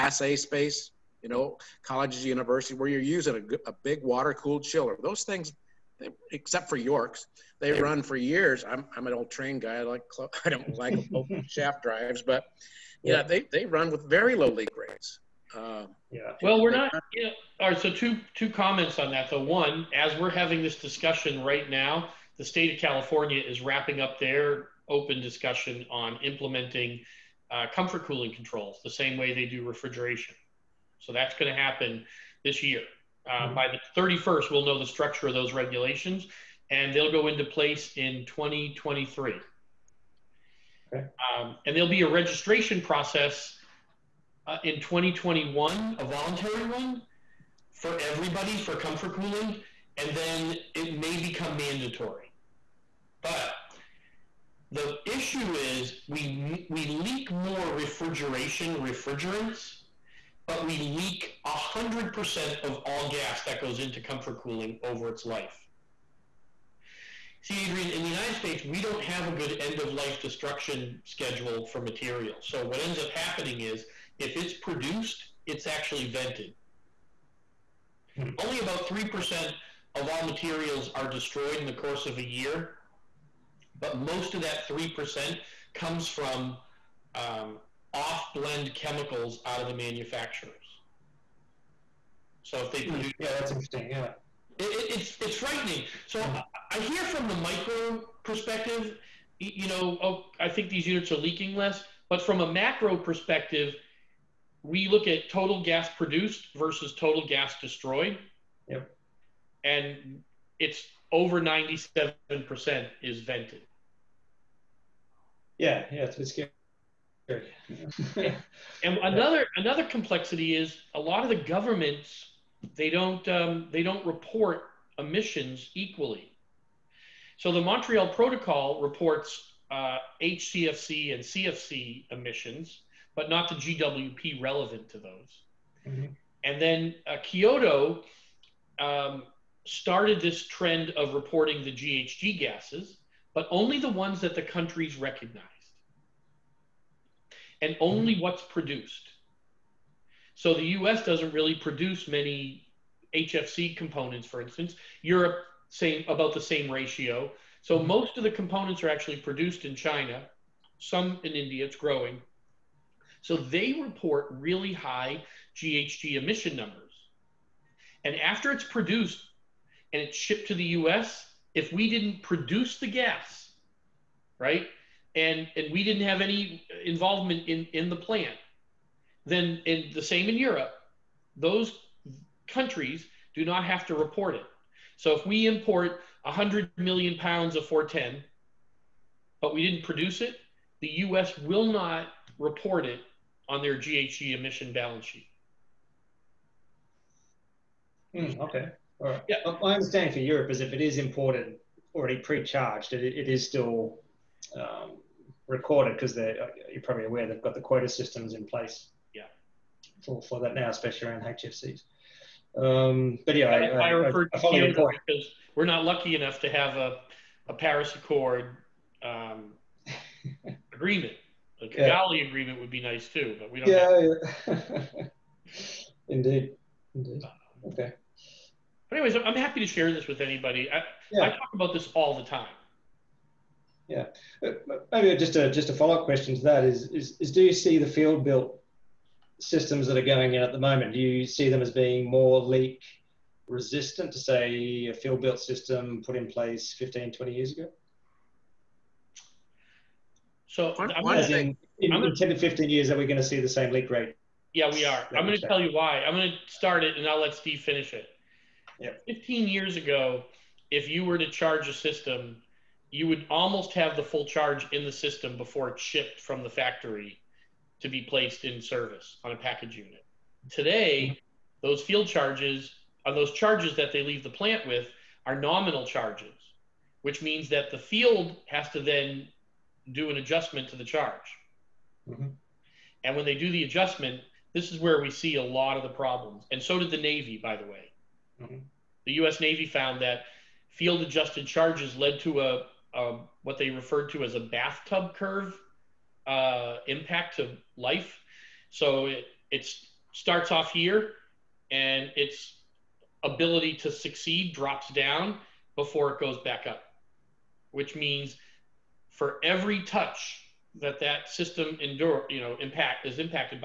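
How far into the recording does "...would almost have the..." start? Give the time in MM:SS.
04:23.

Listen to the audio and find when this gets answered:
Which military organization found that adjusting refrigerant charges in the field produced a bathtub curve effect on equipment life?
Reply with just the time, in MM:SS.
04:49.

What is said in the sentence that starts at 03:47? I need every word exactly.
Okay anyways, I'm happy to share this with anybody.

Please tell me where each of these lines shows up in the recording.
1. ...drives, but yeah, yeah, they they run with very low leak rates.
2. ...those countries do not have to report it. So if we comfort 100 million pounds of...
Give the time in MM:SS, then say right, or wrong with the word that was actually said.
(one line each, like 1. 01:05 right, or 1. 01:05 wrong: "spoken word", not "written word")
1. 00:11 right
2. 03:01 wrong: "import", not "comfort".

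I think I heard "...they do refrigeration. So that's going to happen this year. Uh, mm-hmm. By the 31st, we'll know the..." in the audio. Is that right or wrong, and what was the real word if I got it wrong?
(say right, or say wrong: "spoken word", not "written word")
right.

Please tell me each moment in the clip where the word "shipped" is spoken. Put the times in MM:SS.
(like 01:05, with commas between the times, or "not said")
02:50, 04:25.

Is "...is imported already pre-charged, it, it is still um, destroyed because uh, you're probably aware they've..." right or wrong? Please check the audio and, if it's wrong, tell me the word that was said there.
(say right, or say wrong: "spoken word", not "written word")
wrong: "recorded", not "destroyed".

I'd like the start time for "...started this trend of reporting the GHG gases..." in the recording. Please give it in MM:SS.
02:19.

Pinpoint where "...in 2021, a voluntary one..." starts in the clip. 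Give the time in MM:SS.
00:44.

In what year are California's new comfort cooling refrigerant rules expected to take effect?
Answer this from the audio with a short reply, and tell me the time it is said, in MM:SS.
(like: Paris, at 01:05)
2023, at 00:38.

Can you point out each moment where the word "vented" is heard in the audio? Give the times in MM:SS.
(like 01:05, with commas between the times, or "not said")
01:16, 01:53.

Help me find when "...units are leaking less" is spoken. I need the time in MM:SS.
01:40.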